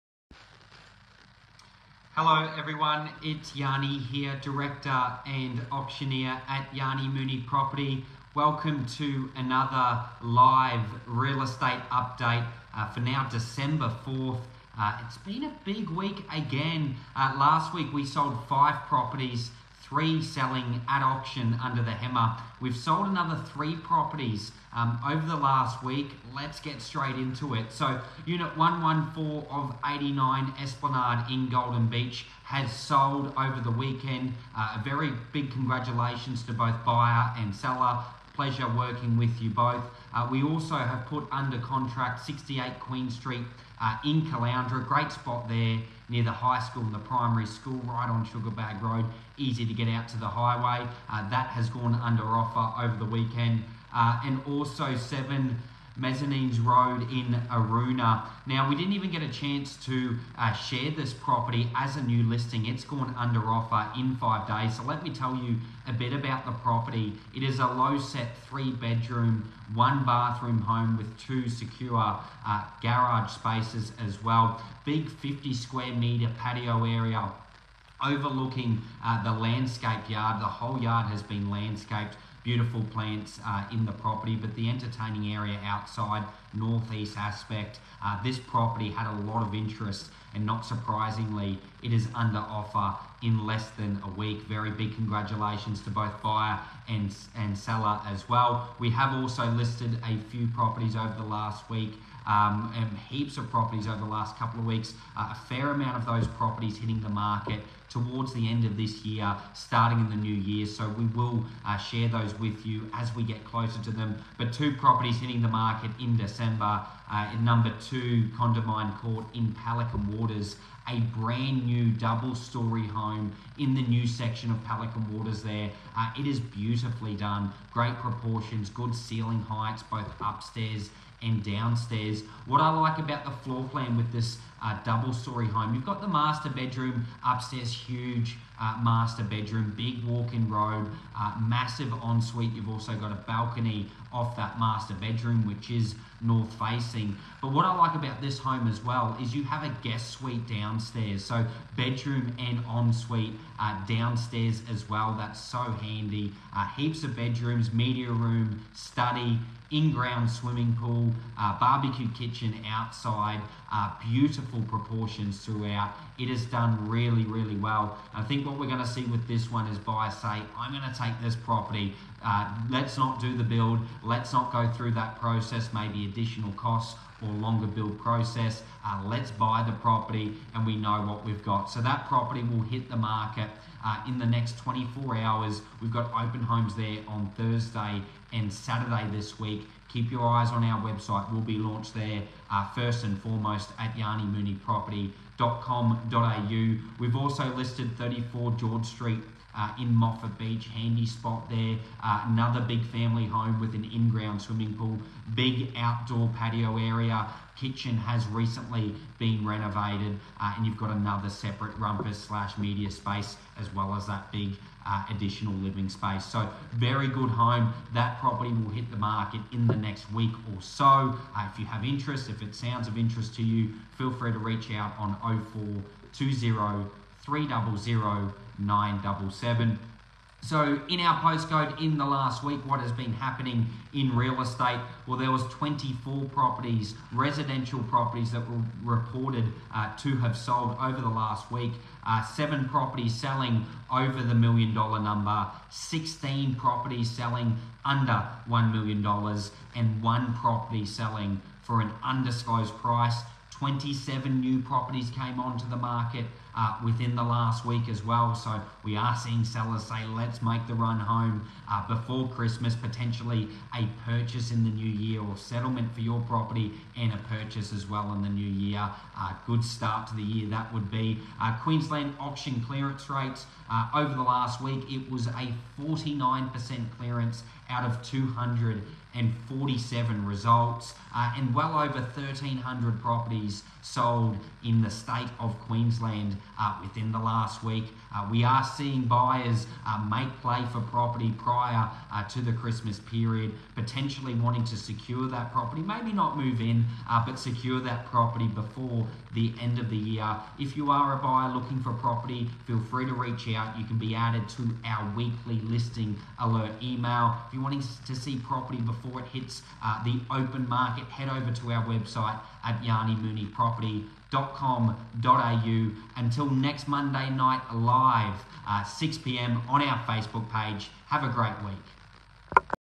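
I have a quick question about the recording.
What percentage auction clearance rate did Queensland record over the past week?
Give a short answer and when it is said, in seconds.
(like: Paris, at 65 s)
49%, at 275 s.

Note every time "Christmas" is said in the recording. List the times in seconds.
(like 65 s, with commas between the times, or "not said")
262 s, 292 s.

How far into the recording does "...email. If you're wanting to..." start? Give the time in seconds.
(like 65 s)
306 s.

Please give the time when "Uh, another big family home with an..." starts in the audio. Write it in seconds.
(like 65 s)
202 s.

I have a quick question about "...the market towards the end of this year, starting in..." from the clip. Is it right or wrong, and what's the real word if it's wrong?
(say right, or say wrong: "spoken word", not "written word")
right.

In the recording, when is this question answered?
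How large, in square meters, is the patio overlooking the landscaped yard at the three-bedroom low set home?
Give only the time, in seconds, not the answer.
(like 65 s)
75 s.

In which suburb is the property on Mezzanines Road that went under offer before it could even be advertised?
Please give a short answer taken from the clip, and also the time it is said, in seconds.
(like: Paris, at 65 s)
Aroona, at 57 s.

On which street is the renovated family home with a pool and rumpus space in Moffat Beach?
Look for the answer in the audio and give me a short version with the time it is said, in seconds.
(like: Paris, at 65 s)
George Street, at 198 s.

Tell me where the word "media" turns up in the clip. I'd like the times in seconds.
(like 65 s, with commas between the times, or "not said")
157 s, 212 s.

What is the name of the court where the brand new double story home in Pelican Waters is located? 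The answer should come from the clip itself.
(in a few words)
Condamine Court.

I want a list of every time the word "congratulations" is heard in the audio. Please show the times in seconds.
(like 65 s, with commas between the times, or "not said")
35 s, 94 s.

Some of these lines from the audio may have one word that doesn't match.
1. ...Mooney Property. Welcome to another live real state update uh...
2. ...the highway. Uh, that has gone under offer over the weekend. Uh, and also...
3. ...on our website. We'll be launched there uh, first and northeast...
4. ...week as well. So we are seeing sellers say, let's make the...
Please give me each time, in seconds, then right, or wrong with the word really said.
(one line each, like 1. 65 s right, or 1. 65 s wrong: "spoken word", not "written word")
1. 7 s wrong: "estate", not "state"
2. 50 s right
3. 190 s wrong: "foremost", not "northeast"
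4. 257 s right.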